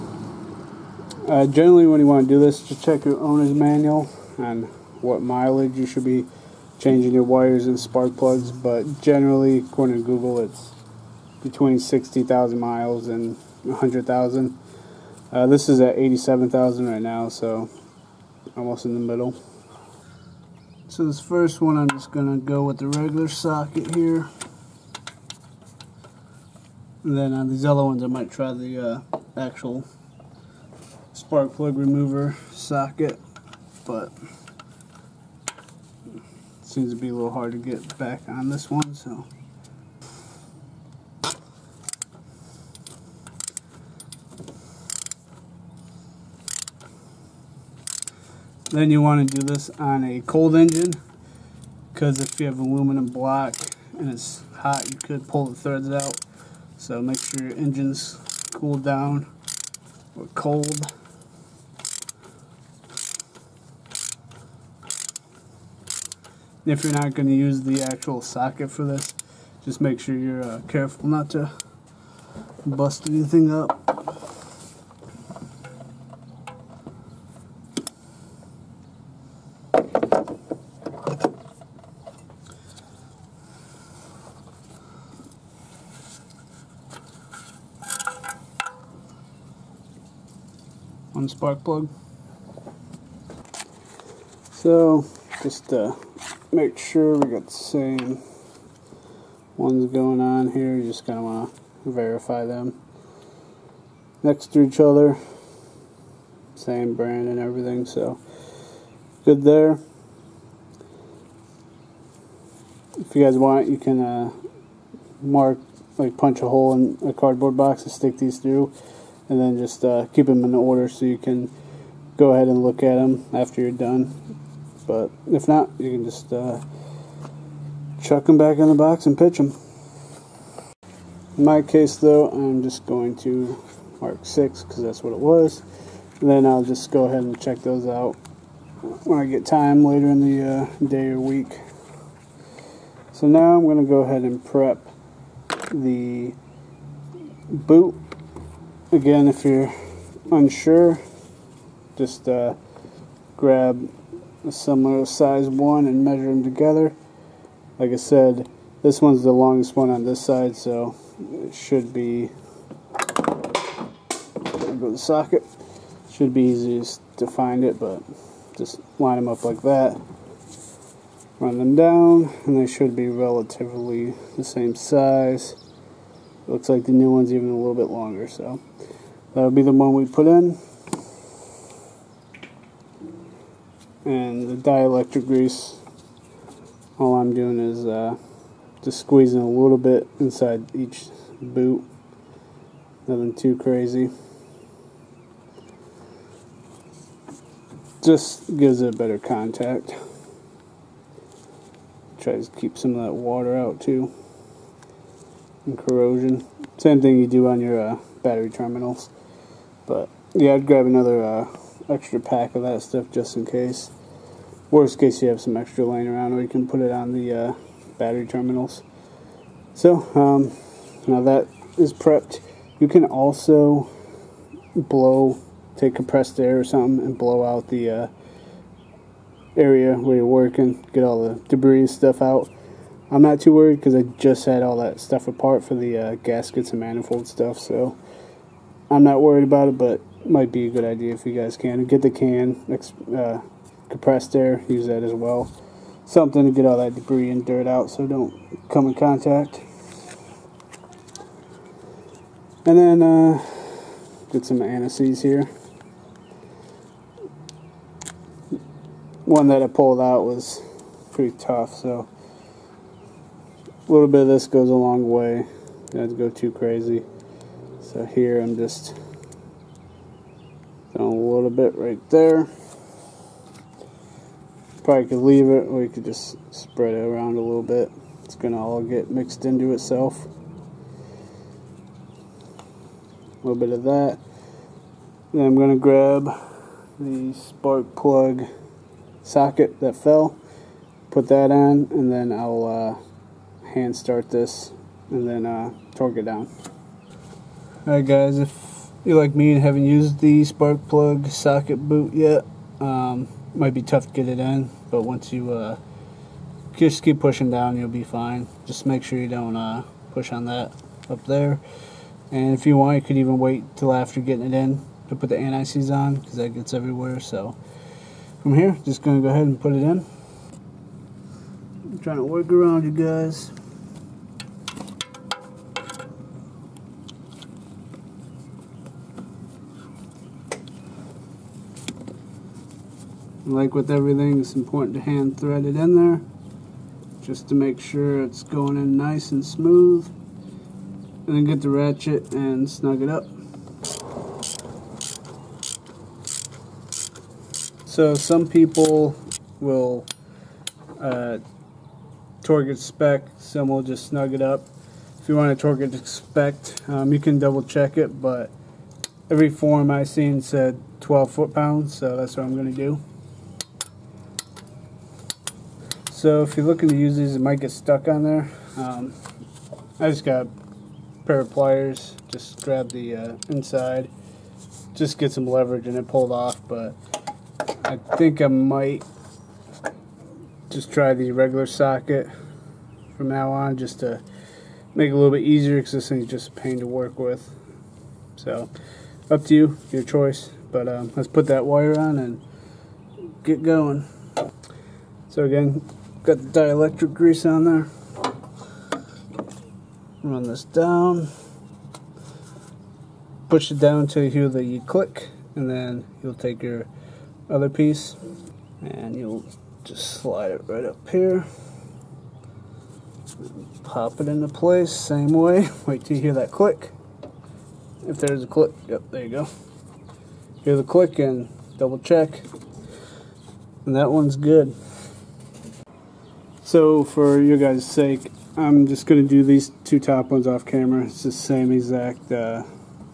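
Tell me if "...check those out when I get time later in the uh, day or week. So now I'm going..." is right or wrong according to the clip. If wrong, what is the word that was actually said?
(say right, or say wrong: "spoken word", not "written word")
right.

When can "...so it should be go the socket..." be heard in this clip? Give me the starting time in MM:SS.
02:40.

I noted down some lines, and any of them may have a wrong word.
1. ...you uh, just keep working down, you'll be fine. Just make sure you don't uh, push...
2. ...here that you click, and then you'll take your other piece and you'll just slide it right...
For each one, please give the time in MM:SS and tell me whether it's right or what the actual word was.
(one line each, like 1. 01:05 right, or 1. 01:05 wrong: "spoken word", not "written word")
1. 05:05 wrong: "pushing", not "working"
2. 06:44 right.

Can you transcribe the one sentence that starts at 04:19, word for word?
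One that I pulled out was pretty tough, so a little bit of this goes a long way.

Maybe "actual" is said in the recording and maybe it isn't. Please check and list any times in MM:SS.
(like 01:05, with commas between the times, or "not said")
00:29, 01:07.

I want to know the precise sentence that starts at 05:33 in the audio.
Like with everything, it's important to hand thread it in there just to make sure it's going in nice and smooth.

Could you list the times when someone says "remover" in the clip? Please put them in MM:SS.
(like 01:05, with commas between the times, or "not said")
00:31.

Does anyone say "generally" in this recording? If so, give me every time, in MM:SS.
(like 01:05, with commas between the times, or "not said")
00:01, 00:08.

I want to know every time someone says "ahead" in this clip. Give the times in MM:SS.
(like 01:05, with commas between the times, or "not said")
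02:02, 02:17, 02:23, 05:19.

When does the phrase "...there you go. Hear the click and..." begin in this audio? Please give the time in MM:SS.
06:59.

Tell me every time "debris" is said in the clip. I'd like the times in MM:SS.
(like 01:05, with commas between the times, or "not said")
03:51, 04:06.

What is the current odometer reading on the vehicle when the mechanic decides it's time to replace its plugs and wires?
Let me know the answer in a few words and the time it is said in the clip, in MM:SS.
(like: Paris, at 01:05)
87,000, at 00:15.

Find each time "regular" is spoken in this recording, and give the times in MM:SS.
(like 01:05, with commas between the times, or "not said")
00:22, 06:21.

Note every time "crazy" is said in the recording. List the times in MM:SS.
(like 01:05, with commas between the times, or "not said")
03:13, 04:26.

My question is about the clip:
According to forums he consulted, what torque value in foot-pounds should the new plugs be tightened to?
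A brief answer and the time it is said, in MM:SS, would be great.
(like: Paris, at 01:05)
12, at 06:01.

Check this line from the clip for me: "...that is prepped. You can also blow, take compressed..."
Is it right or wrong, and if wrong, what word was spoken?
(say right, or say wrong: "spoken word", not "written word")
right.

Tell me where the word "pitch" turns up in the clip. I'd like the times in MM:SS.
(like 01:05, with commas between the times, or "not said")
02:09.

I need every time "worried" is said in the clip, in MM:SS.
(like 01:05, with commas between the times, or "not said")
03:53, 03:59.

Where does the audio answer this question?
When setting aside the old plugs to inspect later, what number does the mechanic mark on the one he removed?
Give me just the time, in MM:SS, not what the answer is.
02:14.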